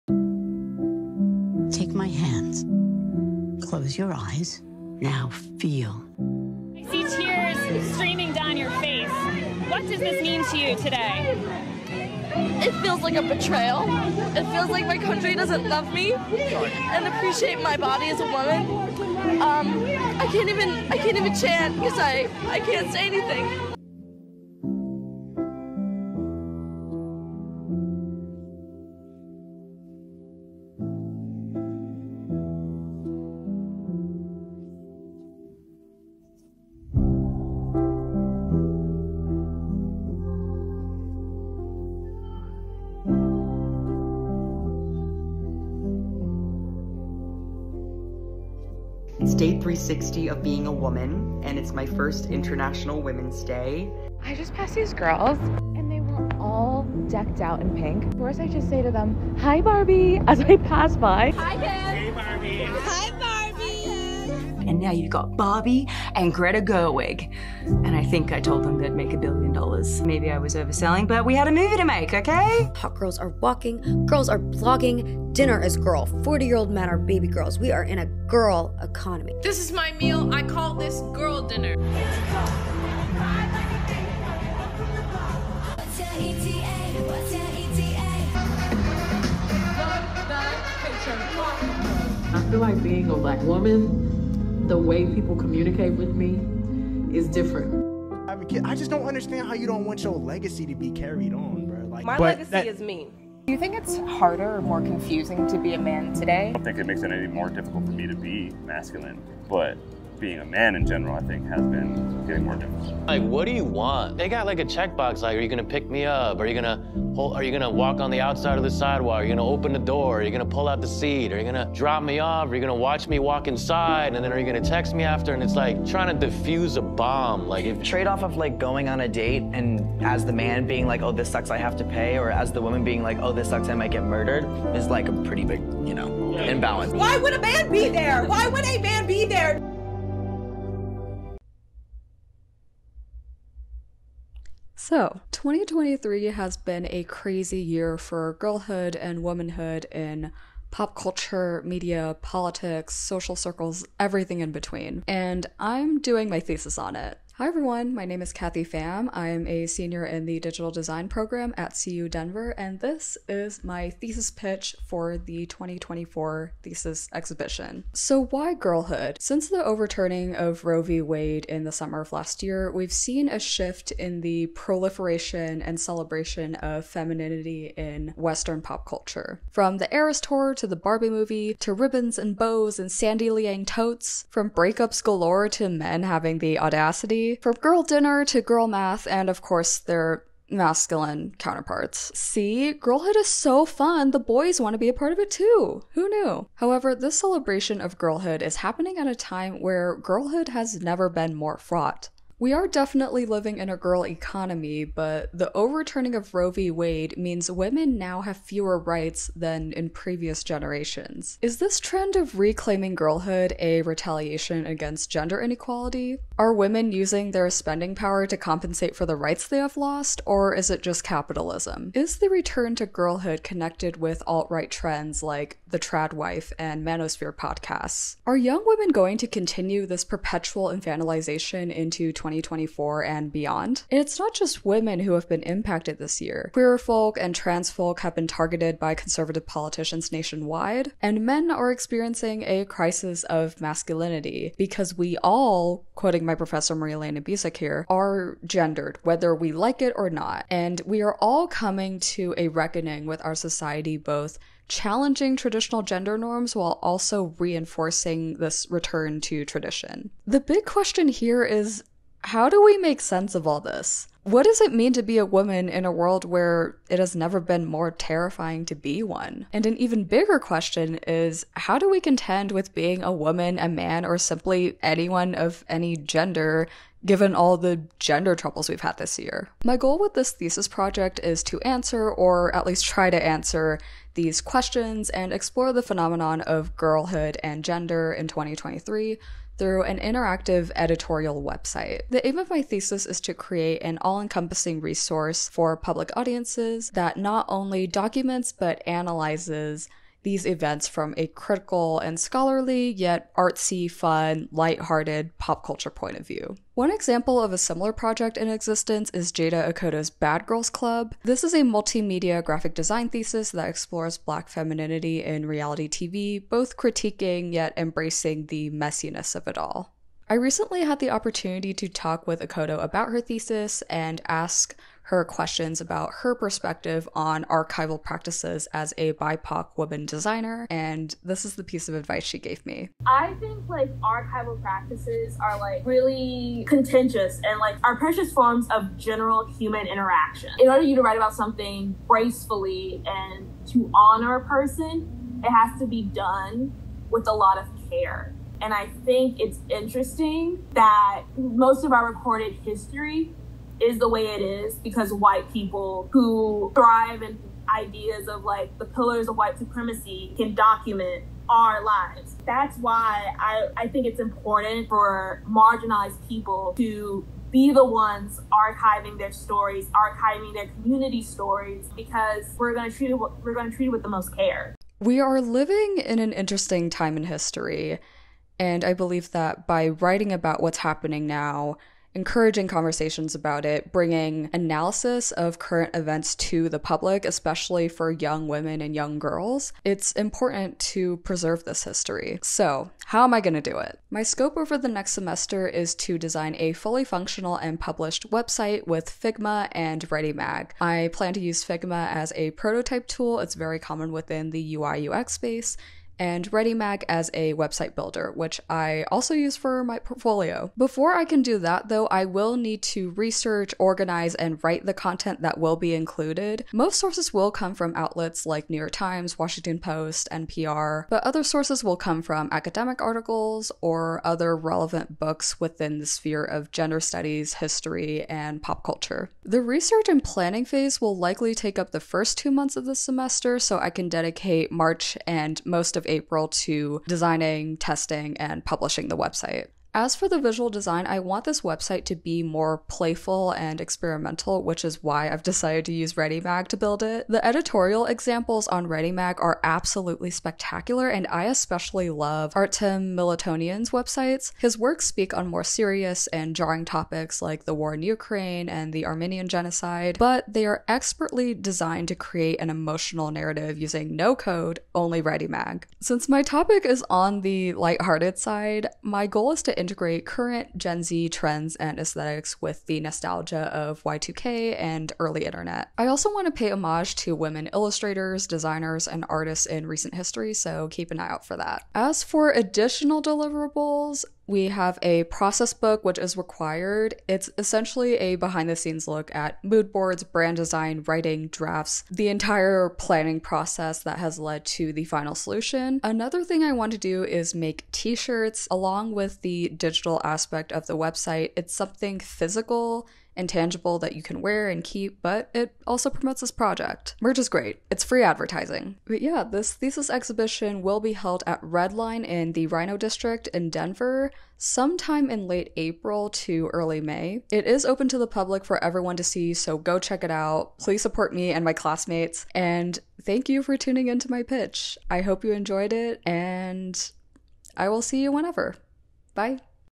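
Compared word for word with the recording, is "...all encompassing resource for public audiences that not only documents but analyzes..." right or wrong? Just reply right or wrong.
right.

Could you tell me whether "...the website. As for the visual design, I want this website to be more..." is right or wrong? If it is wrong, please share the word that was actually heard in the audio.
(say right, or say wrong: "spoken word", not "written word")
right.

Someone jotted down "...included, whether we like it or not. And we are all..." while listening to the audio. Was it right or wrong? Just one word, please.
wrong.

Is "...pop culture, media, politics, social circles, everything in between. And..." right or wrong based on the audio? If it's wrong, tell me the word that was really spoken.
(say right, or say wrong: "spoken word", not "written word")
right.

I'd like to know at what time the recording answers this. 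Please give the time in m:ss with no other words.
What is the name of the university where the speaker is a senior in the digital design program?
2:41.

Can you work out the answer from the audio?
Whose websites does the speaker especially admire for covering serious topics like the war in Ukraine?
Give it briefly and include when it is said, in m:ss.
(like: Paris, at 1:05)
Artem Militonian, at 7:32.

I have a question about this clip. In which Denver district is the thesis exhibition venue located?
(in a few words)
RiNo District.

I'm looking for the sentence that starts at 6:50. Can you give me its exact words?
Before I can do that, though, I will need to research, organize, and write the content that will be included.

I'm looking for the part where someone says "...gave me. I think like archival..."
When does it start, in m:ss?
5:32.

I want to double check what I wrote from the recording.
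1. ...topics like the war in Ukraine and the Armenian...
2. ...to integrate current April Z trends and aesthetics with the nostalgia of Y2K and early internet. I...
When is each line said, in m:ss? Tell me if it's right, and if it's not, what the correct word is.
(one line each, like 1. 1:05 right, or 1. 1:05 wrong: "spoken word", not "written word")
1. 7:36 right
2. 7:49 wrong: "Gen", not "April".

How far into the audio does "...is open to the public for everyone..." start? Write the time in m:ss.
8:37.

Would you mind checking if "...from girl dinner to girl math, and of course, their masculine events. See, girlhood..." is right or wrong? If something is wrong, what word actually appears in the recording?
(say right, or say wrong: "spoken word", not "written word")
wrong: "counterparts", not "events".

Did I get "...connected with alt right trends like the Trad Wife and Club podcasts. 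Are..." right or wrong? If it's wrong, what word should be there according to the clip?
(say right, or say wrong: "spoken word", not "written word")
wrong: "Manosphere", not "Club".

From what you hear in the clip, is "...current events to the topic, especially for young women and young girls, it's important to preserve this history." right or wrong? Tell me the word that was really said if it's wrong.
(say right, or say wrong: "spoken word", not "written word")
wrong: "public", not "topic".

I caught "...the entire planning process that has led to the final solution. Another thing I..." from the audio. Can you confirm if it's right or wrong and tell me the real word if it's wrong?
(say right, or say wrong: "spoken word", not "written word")
right.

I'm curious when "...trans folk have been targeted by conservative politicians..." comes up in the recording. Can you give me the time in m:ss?
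3:57.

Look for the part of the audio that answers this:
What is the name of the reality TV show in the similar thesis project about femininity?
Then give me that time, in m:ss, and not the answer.
5:10.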